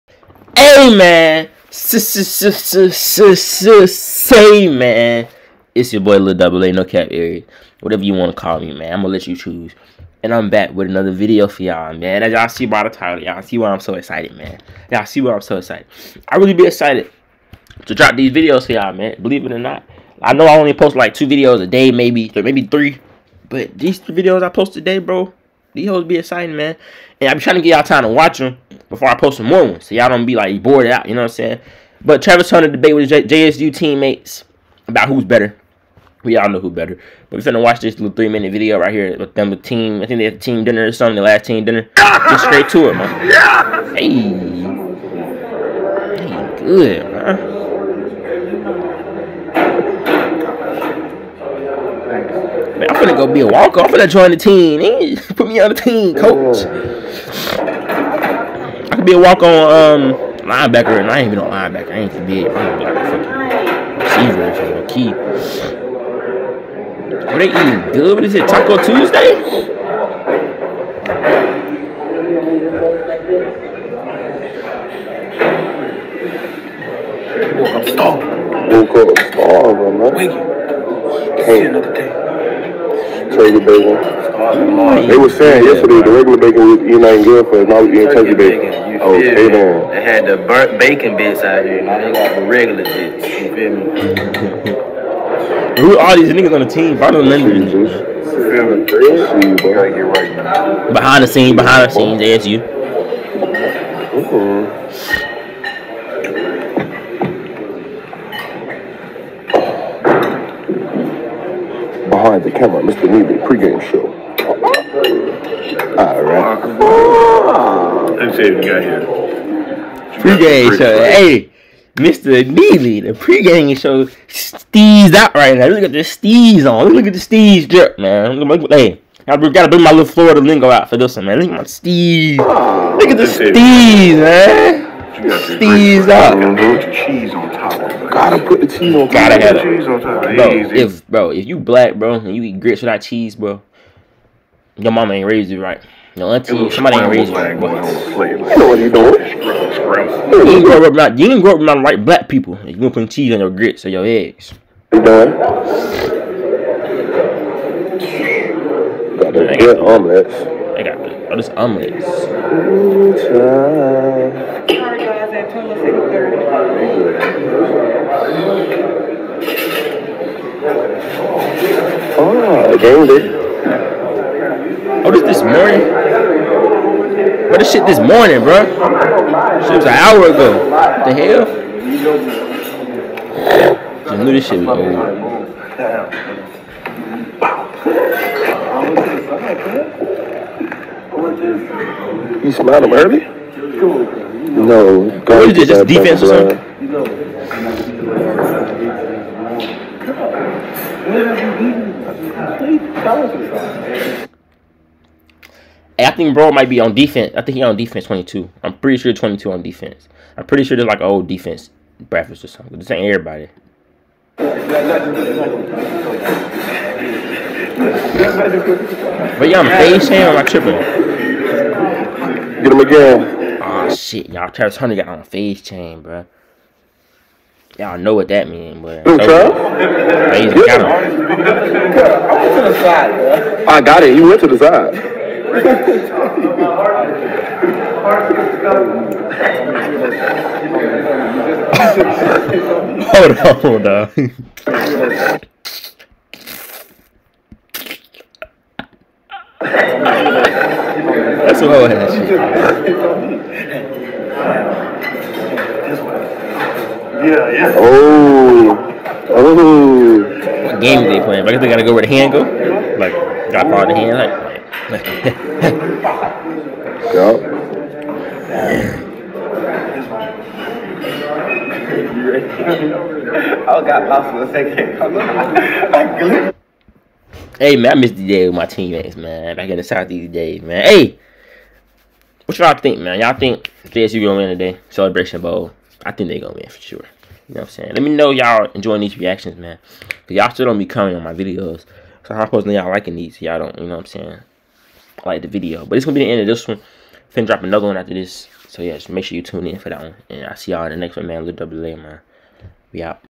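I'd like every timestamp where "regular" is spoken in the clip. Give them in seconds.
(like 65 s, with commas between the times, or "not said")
86 s, 92 s.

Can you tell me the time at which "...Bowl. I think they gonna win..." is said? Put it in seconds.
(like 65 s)
285 s.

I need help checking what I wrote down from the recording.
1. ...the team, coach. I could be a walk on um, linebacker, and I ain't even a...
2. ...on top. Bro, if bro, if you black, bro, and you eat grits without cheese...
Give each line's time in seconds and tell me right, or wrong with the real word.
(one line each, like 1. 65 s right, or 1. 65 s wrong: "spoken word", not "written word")
1. 55 s right
2. 139 s right.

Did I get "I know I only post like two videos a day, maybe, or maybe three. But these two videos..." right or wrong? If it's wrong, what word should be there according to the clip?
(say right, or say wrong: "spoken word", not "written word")
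right.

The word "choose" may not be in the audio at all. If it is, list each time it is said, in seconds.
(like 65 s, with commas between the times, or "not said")
9 s.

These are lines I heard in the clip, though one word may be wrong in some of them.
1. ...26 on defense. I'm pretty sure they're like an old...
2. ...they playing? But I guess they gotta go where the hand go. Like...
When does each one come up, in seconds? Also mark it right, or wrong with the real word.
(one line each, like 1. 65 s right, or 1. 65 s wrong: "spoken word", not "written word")
1. 209 s wrong: "22", not "26"
2. 261 s right.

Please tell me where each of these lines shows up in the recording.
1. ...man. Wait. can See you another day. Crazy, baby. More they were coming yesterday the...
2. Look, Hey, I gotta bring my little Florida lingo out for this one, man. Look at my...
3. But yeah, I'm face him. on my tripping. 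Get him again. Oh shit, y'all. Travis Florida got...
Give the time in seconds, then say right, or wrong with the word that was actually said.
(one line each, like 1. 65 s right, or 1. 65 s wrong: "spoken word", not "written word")
1. 79 s wrong: "saying", not "coming"
2. 128 s right
3. 214 s wrong: "Hunter", not "Florida".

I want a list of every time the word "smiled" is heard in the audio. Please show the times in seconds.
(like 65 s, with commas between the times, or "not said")
192 s.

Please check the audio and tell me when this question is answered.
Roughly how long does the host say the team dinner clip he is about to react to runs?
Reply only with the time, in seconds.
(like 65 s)
38 s.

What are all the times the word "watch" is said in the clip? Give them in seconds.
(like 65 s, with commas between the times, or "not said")
28 s, 37 s.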